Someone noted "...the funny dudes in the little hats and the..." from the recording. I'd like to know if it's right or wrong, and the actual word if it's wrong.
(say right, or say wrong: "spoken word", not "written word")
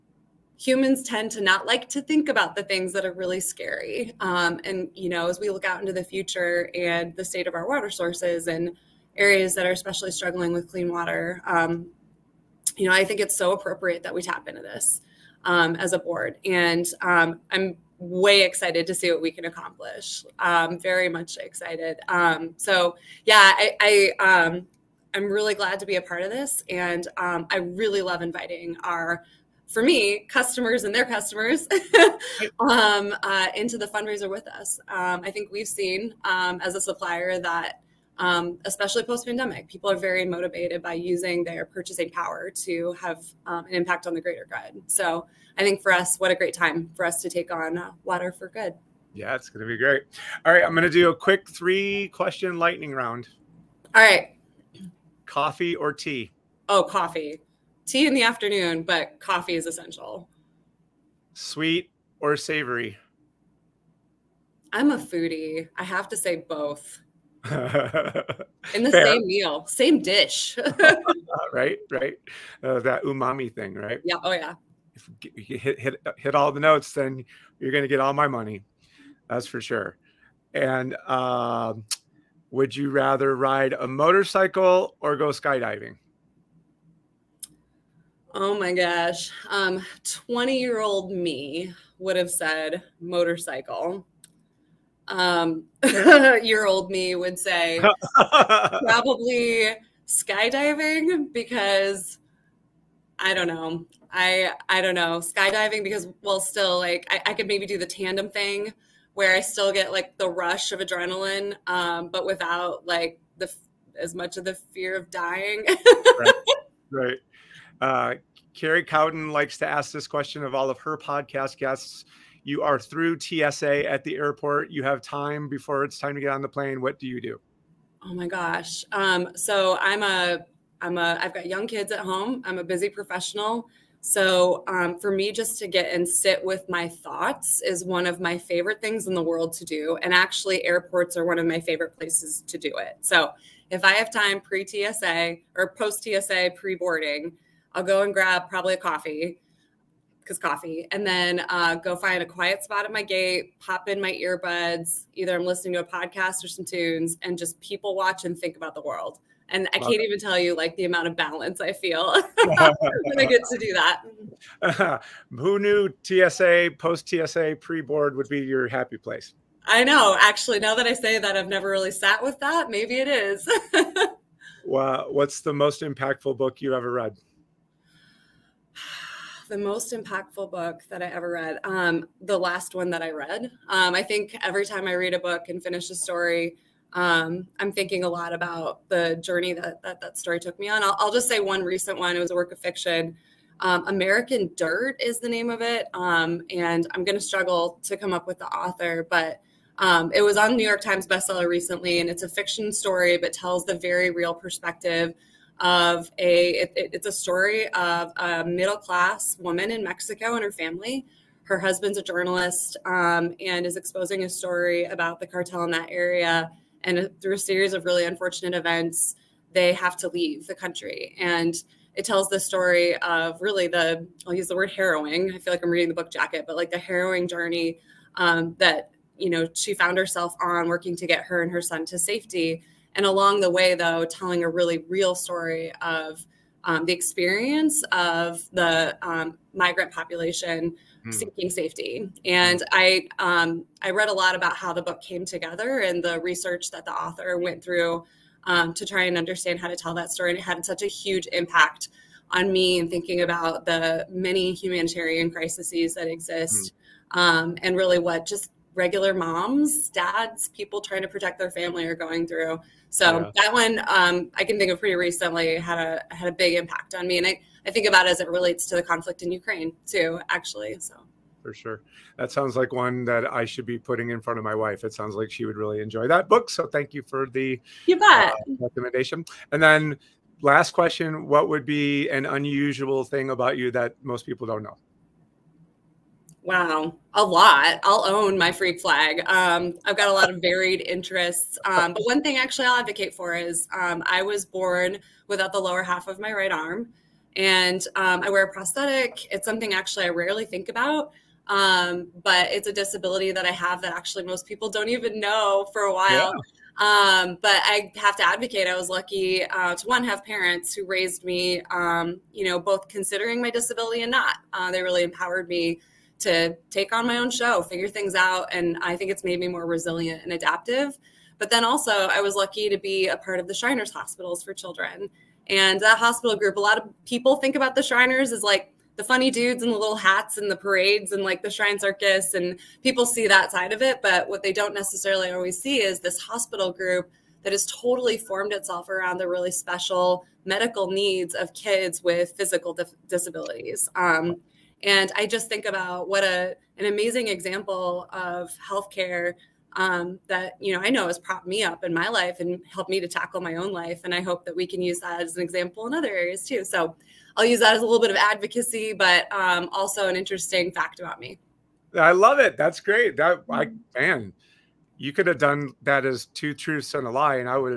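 right.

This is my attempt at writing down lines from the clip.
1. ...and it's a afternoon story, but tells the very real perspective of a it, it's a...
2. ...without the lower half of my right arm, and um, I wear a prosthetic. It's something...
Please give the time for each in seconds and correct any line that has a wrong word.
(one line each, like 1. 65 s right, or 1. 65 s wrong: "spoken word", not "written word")
1. 201 s wrong: "fiction", not "afternoon"
2. 295 s right.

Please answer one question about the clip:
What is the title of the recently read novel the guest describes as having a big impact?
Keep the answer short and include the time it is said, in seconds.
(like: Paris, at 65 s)
American Dirt, at 193 s.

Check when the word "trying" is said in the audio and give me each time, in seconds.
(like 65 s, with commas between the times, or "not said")
260 s.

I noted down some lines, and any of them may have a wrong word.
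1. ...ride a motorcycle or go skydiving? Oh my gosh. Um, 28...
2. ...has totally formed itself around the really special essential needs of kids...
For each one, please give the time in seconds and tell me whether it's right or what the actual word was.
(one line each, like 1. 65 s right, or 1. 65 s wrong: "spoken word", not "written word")
1. 83 s wrong: "20", not "28"
2. 337 s wrong: "medical", not "essential".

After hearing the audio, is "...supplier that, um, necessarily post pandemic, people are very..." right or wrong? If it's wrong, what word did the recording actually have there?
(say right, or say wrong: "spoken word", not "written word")
wrong: "especially", not "necessarily".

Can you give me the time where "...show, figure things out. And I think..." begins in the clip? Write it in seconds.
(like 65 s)
317 s.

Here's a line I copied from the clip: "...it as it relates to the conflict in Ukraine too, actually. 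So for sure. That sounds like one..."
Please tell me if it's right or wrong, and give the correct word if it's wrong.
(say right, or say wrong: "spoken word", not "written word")
right.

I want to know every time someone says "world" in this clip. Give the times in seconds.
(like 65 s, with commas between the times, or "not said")
139 s, 158 s.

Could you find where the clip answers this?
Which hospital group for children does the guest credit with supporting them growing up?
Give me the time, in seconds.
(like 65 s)
323 s.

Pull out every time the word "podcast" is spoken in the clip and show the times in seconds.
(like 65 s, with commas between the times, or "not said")
120 s, 155 s.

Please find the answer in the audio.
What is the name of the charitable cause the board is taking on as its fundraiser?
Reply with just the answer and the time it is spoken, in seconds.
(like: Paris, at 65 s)
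Water for Good, at 48 s.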